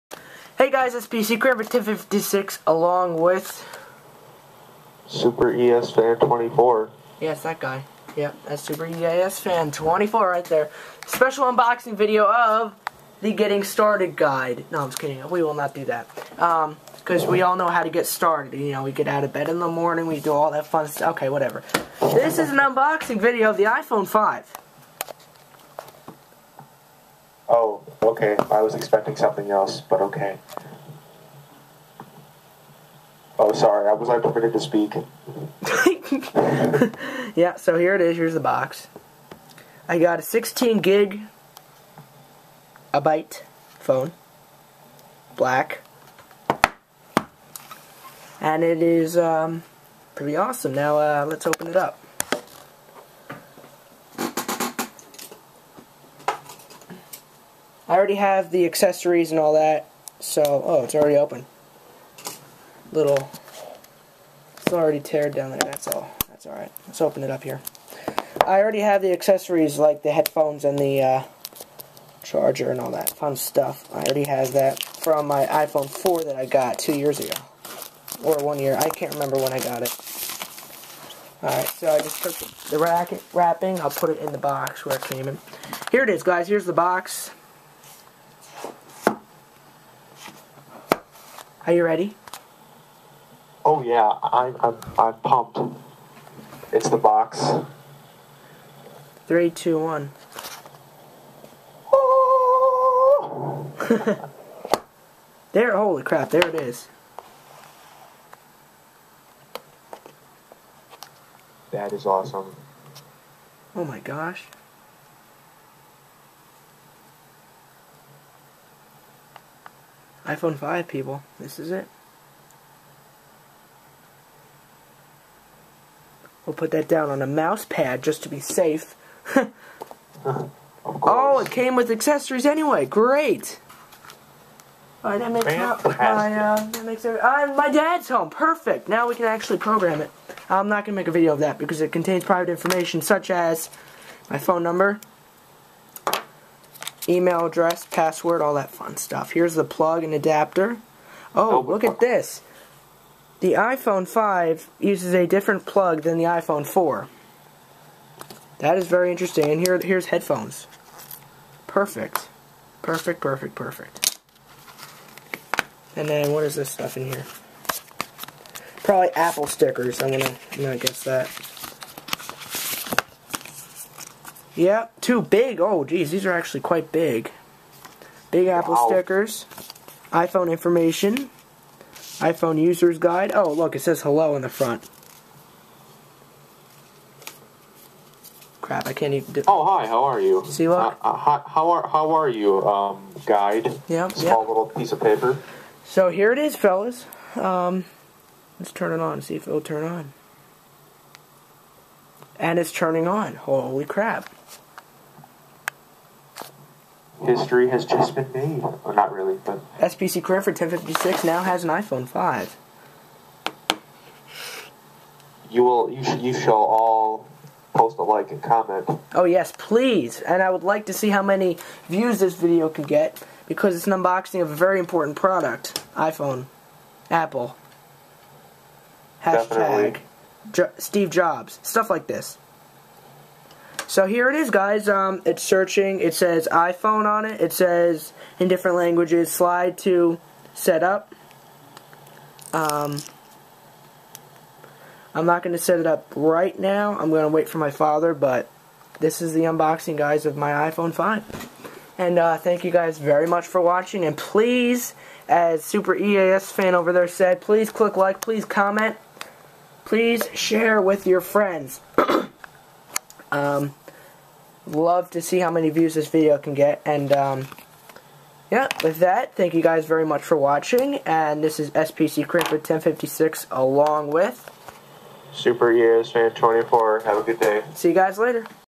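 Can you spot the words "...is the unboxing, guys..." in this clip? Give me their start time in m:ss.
4:09.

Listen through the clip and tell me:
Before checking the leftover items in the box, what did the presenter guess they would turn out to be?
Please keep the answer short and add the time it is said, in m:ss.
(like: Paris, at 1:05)
Apple stickers, at 2:49.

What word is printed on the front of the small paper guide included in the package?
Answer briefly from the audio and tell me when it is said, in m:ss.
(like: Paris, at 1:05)
hello, at 3:04.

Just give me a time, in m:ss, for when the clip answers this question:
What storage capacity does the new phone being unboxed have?
0:40.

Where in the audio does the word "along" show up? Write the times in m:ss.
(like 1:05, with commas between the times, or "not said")
0:02, 4:33.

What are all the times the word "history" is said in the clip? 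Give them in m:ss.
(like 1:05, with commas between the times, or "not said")
3:27.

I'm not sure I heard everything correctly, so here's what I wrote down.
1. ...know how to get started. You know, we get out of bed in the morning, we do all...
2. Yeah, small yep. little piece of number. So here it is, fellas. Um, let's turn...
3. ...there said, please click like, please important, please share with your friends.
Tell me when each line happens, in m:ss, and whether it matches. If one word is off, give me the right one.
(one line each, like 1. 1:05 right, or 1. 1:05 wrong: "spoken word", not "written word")
1. 0:17 right
2. 3:13 wrong: "paper", not "number"
3. 4:16 wrong: "comment", not "important".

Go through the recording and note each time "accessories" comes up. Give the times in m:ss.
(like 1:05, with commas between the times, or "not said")
0:58, 1:09, 2:11.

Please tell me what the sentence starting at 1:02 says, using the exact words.
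Little, it's already teared down there, that's all.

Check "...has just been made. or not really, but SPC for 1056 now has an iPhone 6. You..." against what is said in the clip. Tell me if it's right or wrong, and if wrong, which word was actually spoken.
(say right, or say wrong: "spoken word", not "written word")
wrong: "5", not "6".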